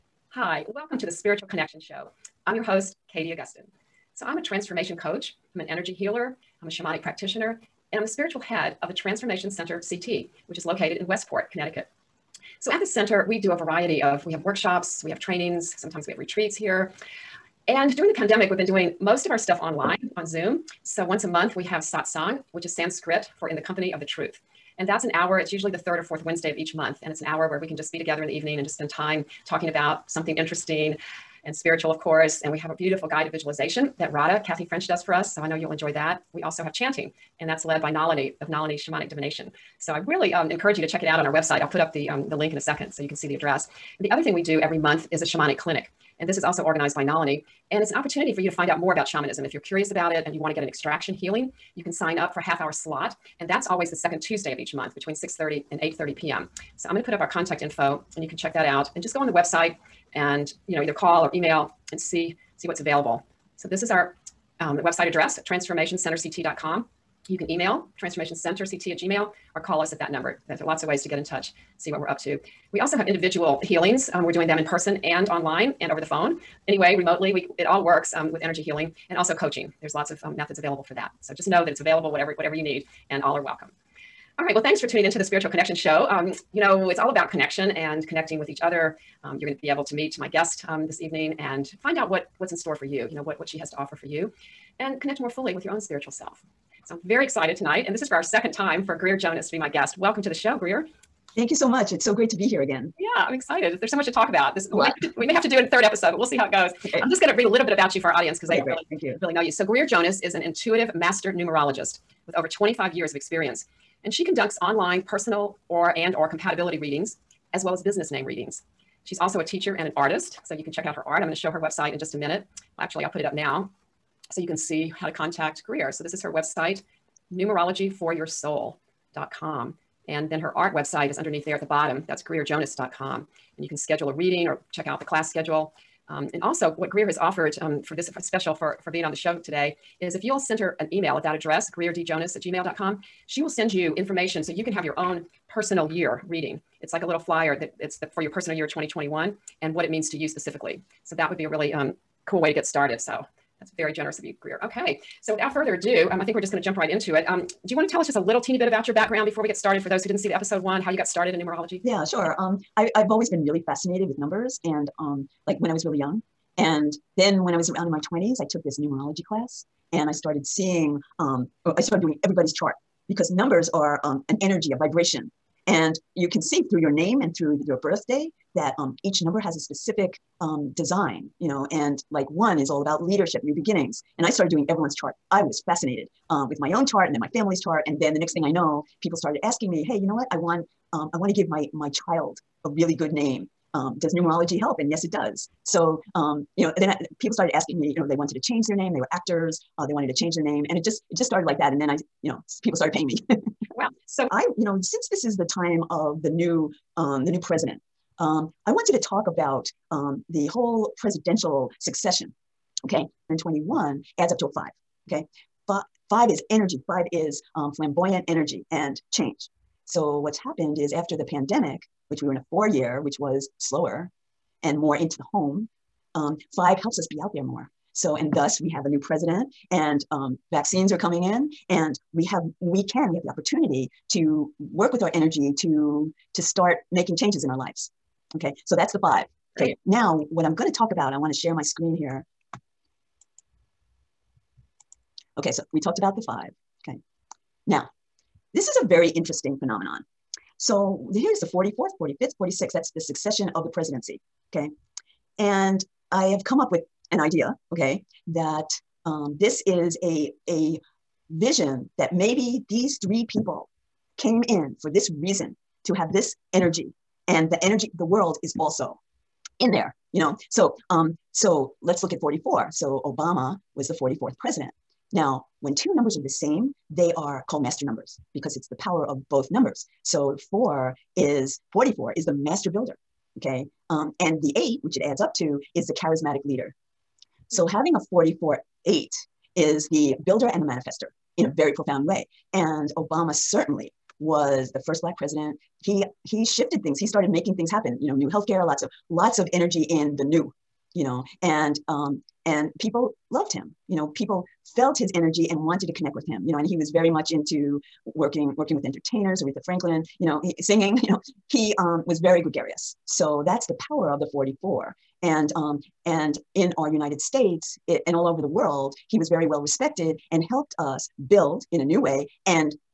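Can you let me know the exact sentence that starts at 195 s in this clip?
So um, you know, then I, people started asking me.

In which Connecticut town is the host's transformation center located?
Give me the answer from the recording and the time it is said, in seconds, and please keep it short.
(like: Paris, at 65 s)
Westport, at 11 s.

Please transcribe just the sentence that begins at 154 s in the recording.
Okay, so without further ado, um, I think we're just going to jump right into it.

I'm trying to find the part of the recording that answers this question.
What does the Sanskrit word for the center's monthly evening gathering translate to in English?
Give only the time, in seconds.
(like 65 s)
23 s.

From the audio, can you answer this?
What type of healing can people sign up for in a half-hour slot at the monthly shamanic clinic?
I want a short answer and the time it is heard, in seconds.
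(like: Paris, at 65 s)
Extraction healing, at 50 s.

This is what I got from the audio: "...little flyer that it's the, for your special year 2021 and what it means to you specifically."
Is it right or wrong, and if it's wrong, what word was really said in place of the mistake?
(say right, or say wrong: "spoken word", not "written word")
wrong: "personal", not "special".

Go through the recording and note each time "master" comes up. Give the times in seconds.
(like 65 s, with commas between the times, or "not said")
110 s, 277 s, 282 s.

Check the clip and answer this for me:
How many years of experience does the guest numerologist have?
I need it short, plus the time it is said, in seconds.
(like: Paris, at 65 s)
25, at 112 s.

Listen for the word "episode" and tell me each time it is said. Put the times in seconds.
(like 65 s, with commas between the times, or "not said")
105 s, 160 s.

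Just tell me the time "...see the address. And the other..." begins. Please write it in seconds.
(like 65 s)
43 s.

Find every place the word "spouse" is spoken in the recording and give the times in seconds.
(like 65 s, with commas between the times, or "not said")
not said.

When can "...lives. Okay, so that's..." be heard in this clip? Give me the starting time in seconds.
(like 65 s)
237 s.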